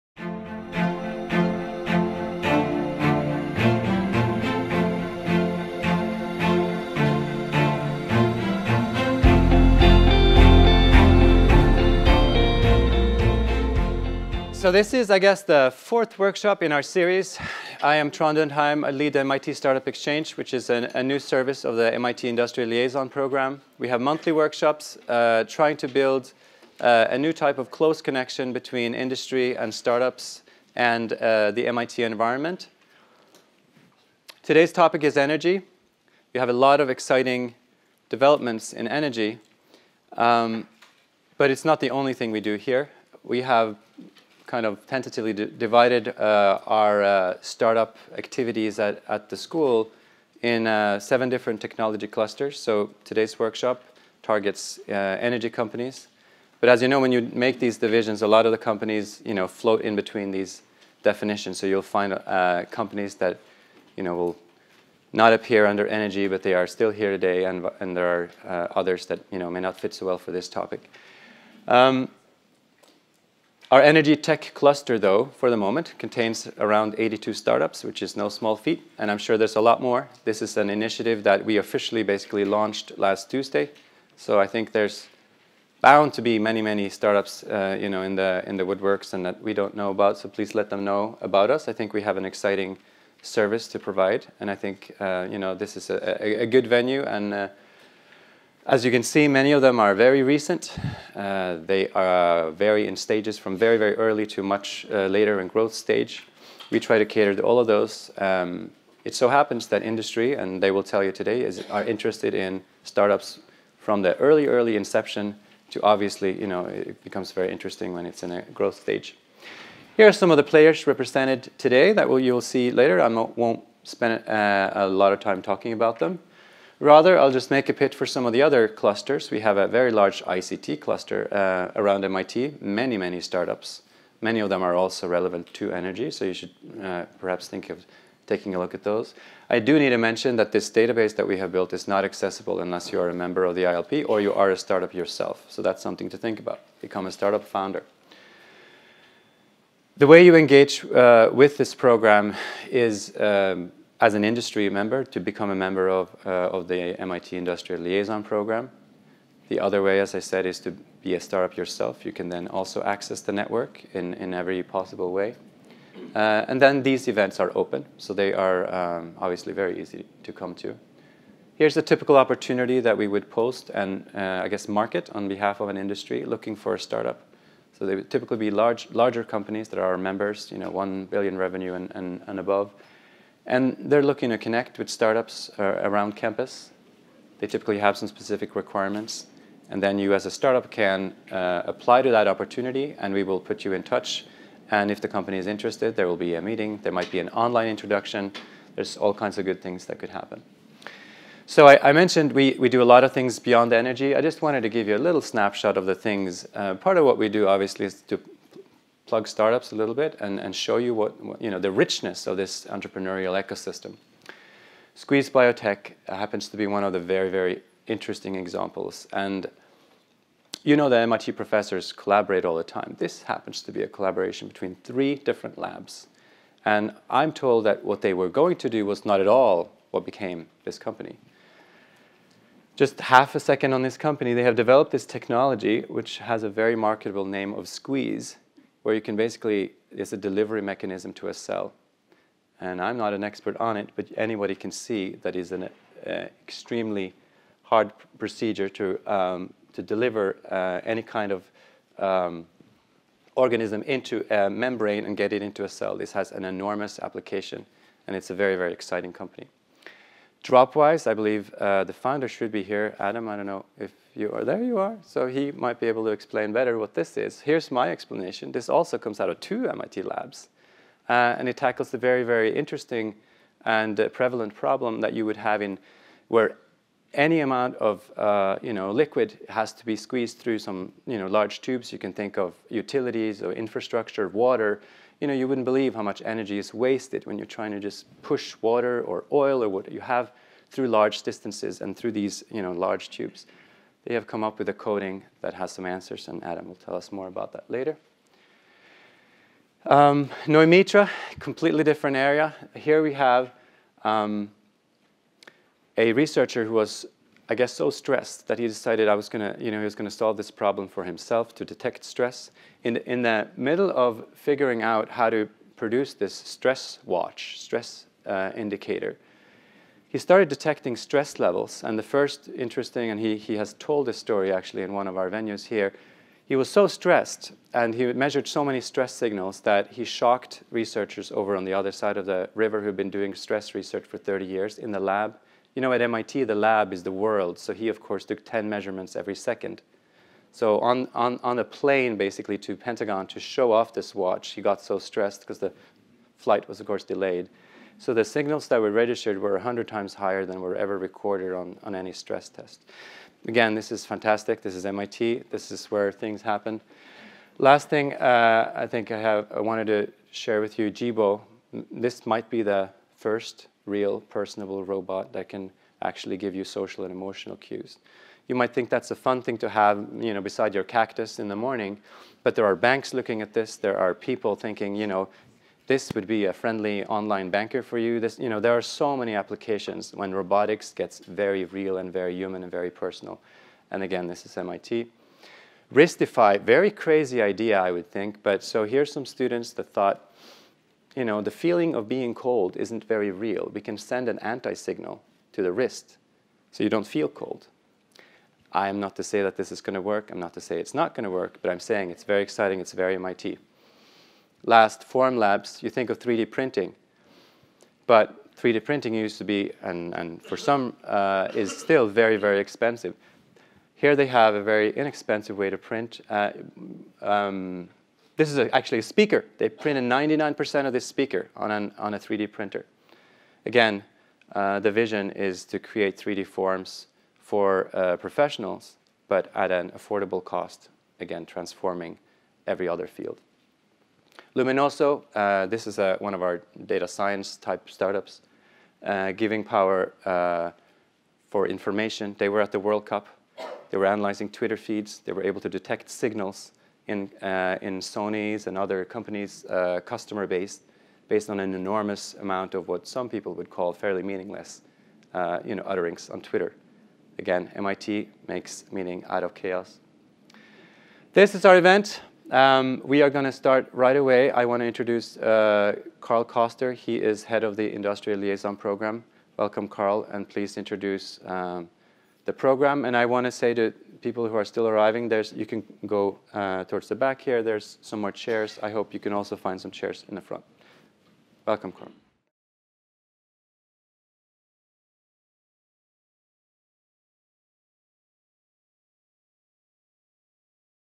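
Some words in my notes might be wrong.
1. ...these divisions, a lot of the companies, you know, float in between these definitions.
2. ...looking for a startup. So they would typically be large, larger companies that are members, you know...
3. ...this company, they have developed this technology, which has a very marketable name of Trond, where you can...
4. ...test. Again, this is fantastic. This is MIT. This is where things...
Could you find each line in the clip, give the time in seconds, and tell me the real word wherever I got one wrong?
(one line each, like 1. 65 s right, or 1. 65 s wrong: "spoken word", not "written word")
1. 57 s right
2. 176 s right
3. 233 s wrong: "SQZ", not "Trond"
4. 352 s right.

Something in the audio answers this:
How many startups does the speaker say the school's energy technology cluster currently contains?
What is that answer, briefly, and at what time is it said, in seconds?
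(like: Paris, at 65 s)
82, at 76 s.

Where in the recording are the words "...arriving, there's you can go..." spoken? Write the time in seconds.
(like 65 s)
474 s.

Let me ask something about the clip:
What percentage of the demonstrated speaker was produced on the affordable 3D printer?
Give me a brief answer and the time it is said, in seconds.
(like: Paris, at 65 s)
99%, at 419 s.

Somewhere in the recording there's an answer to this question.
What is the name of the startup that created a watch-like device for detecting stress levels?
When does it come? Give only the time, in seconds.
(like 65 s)
300 s.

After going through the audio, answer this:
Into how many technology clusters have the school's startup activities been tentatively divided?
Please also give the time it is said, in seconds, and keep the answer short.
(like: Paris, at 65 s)
7, at 50 s.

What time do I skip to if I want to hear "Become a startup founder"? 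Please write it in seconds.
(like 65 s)
146 s.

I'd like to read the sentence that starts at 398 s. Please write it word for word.
I am not to say that this is going to work.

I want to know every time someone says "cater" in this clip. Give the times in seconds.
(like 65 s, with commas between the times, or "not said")
107 s.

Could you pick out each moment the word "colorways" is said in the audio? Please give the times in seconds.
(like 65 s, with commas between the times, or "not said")
not said.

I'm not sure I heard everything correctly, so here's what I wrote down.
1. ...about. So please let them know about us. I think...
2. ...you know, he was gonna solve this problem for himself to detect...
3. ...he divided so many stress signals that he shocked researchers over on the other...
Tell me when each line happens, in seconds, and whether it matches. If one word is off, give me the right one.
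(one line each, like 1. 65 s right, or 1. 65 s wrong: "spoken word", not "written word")
1. 89 s right
2. 309 s right
3. 327 s wrong: "measured", not "divided".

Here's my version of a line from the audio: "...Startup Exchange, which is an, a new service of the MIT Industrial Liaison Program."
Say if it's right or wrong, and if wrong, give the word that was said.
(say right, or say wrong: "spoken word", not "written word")
right.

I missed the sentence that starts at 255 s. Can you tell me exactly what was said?
This has an enormous application, and it's a very, very exciting company.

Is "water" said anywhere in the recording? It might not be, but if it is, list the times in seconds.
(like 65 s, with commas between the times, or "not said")
284 s, 288 s.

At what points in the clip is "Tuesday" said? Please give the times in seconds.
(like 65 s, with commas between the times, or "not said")
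83 s.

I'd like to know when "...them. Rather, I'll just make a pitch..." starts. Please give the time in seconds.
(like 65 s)
125 s.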